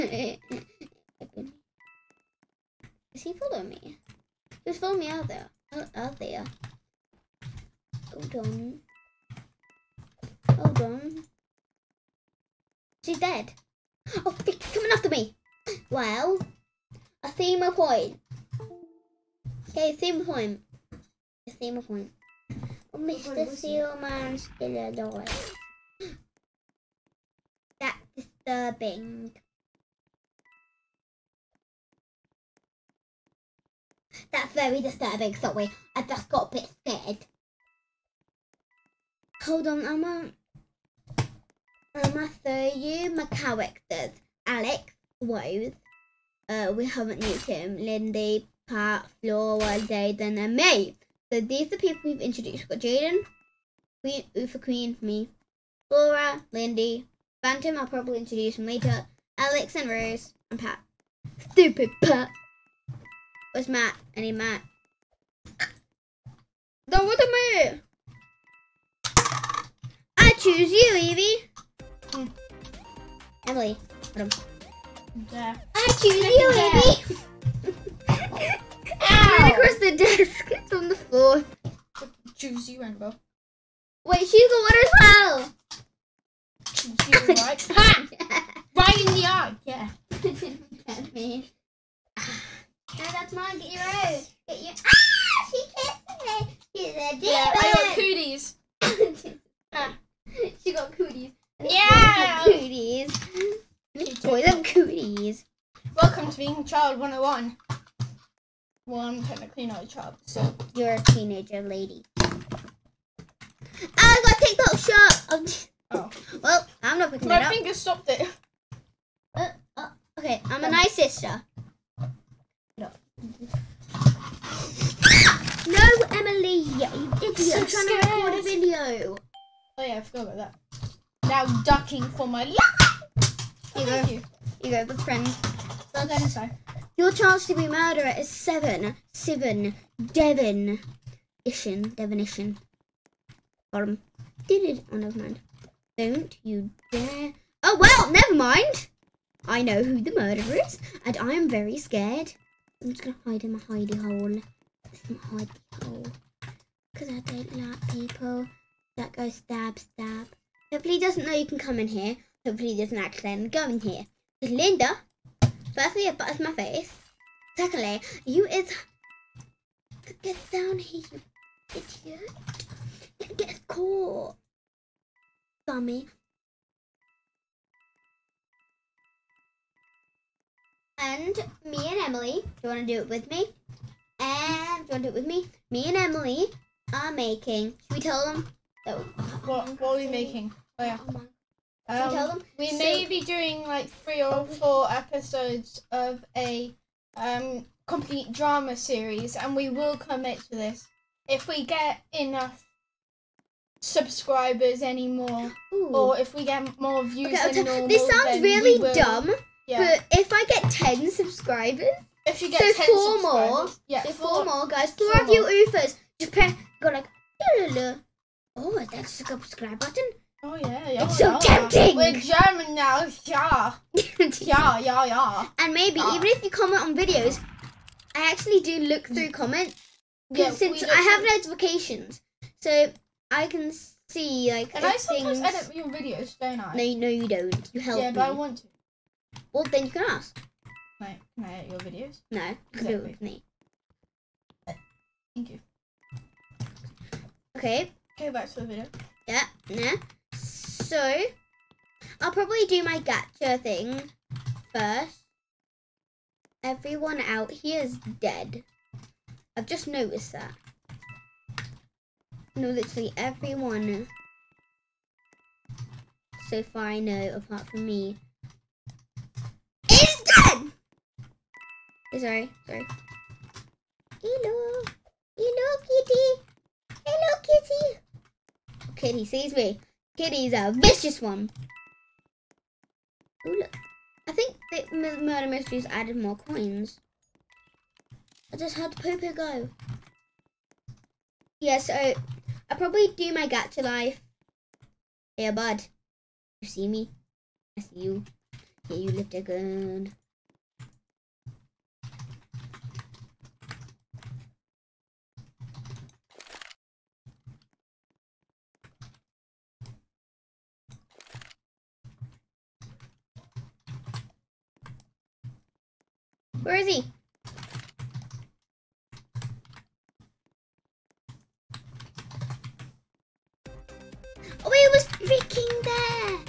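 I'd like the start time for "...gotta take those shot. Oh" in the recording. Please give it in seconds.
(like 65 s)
113 s.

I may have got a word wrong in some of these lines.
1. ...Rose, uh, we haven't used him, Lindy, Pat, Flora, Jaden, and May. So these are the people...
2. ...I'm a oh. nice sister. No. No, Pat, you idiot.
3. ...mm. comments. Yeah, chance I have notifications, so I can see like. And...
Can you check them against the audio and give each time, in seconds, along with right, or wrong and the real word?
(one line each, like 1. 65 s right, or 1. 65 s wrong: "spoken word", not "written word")
1. 45 s right
2. 120 s wrong: "Emily", not "Pat"
3. 229 s wrong: "since", not "chance".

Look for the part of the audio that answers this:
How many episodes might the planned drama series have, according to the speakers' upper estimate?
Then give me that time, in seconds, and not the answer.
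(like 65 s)
193 s.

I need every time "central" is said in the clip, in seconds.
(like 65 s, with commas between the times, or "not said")
not said.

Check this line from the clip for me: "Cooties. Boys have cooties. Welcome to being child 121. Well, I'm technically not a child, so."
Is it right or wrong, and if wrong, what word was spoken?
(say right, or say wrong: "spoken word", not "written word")
wrong: "101", not "121".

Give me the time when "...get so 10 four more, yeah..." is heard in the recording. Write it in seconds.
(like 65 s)
212 s.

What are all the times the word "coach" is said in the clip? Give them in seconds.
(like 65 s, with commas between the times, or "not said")
not said.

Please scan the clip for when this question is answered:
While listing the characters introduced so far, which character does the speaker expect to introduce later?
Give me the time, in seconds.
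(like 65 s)
57 s.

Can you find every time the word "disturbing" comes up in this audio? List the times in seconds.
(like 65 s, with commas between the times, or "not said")
28 s, 34 s.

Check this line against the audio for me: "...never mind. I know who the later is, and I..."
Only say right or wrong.
wrong.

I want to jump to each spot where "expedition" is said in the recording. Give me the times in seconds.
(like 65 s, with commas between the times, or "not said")
not said.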